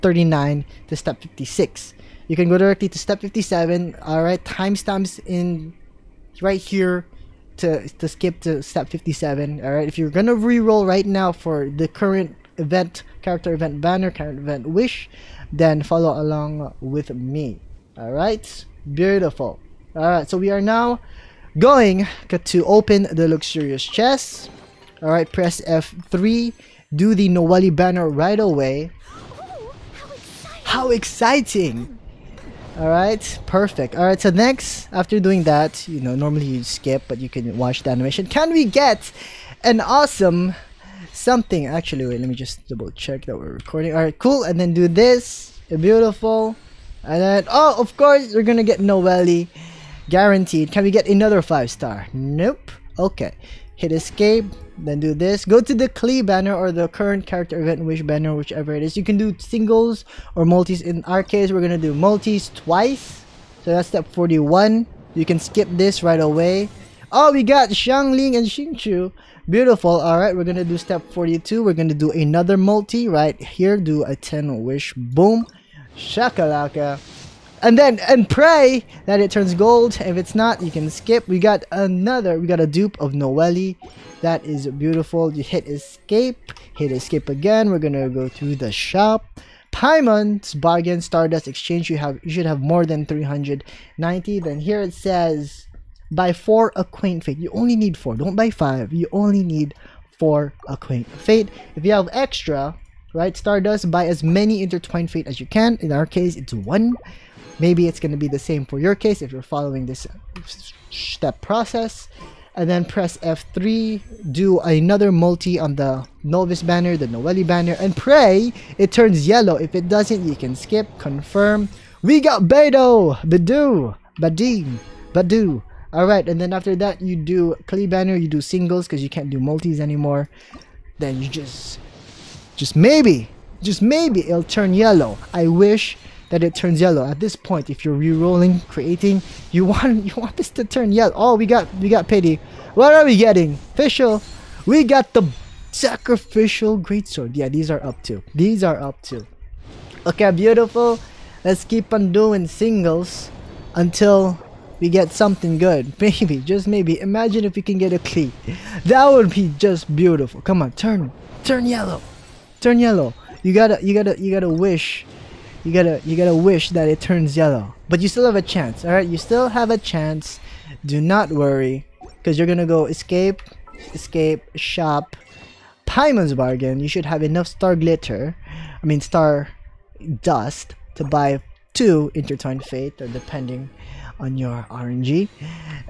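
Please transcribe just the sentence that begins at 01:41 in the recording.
If you have extra, right, Stardust, buy as many intertwined fate as you can.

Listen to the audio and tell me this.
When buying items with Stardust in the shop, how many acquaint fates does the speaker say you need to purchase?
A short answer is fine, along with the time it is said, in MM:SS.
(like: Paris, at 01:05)
4, at 01:36.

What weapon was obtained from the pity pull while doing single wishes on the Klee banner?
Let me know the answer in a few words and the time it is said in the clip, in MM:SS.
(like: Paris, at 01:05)
Sacrificial Greatsword, at 02:25.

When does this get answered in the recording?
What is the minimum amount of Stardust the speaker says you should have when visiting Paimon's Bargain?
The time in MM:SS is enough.
01:32.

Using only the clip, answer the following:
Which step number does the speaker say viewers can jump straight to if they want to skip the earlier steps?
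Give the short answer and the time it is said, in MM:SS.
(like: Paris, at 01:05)
57, at 00:02.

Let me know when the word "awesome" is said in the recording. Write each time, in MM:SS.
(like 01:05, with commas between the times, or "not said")
00:39.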